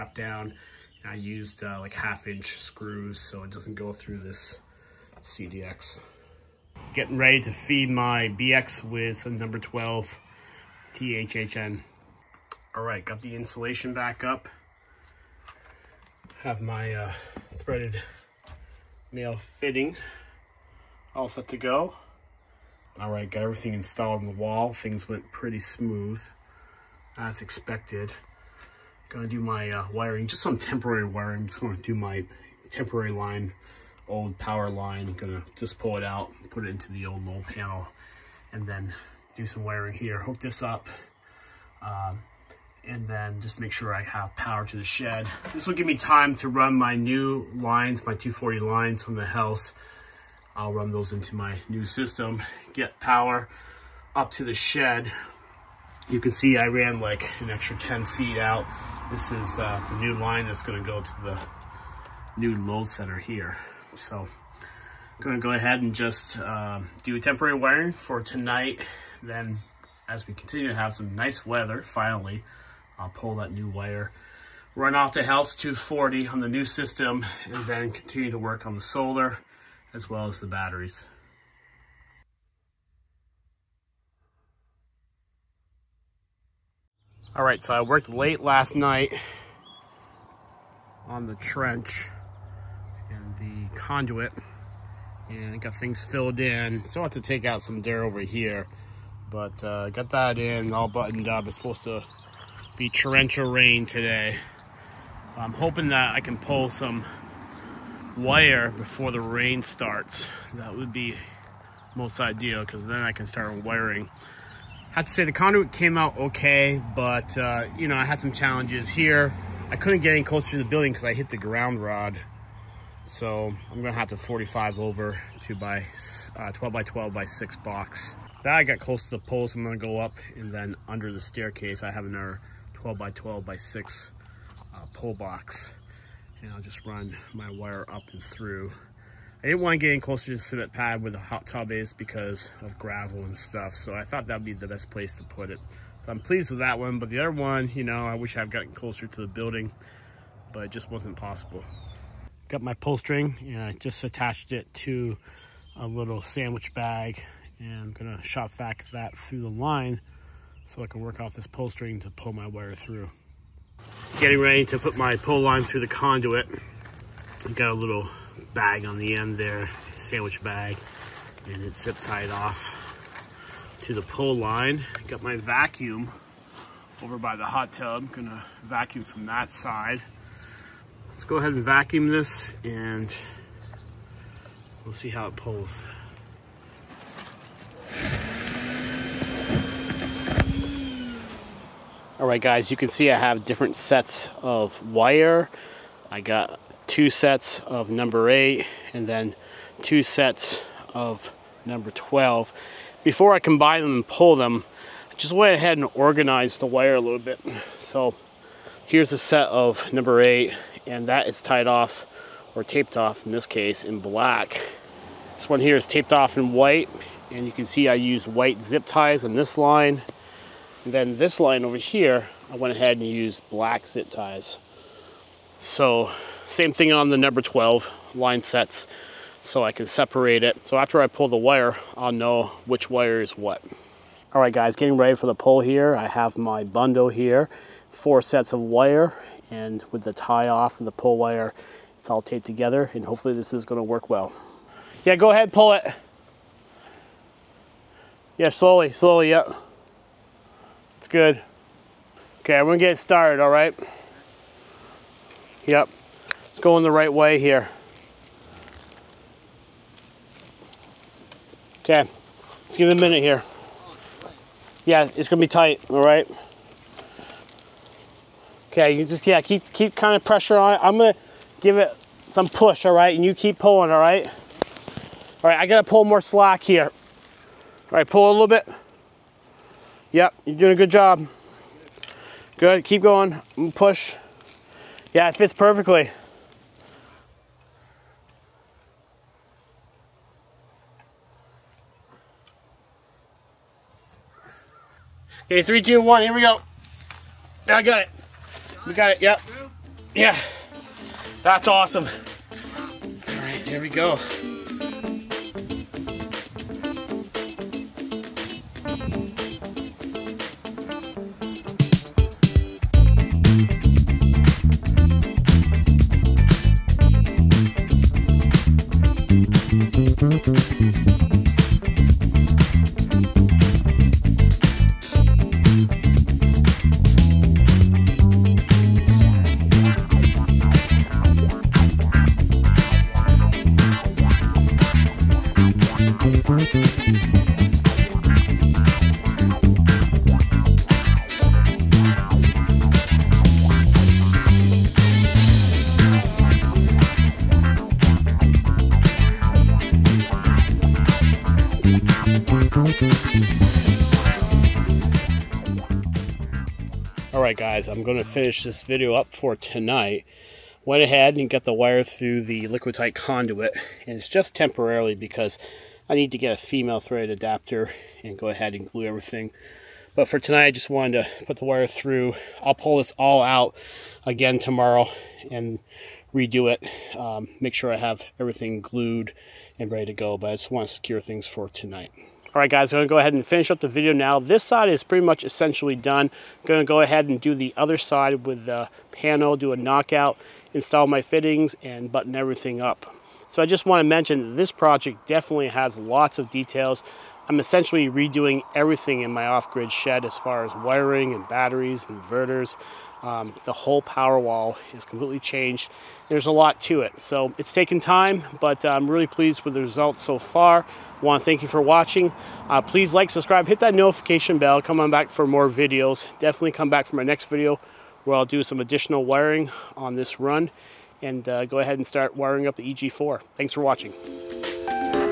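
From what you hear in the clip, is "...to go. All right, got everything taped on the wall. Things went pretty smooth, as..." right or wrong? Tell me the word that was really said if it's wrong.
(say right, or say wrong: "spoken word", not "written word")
wrong: "installed", not "taped".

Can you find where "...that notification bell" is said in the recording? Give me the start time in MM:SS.
06:53.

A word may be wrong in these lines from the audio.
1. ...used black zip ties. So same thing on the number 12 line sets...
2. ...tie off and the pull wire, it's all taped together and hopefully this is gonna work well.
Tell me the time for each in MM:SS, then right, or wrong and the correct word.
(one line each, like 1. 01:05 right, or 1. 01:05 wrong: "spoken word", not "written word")
1. 03:43 right
2. 04:00 right.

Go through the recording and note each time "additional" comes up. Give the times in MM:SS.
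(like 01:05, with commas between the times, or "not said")
06:58.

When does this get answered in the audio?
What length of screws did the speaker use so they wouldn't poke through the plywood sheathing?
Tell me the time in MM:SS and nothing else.
00:01.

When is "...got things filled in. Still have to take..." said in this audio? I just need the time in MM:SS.
01:35.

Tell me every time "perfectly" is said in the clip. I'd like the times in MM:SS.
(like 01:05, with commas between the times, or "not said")
04:45.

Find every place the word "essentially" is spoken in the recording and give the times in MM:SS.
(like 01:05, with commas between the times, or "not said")
06:25, 06:37.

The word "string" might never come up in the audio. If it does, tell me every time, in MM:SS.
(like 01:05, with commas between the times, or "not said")
02:32, 02:41.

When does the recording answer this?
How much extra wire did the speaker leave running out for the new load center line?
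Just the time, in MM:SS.
00:57.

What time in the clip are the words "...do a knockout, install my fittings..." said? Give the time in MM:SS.
06:29.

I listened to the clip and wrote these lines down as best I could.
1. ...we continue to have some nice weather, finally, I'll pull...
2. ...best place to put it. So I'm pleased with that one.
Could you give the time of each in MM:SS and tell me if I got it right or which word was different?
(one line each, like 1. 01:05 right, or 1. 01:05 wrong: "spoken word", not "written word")
1. 01:10 right
2. 02:24 right.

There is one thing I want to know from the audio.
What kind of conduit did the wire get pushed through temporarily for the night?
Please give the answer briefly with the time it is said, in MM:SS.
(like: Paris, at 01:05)
liquid tight, at 06:02.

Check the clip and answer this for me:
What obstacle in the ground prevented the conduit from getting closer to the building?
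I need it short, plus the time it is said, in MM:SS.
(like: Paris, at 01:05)
ground rod, at 02:01.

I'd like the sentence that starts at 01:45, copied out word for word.
I'm hoping that I can pull some wire before the rain starts.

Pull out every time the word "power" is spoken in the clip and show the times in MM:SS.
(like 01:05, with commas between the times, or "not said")
00:34, 00:44, 00:52, 06:44.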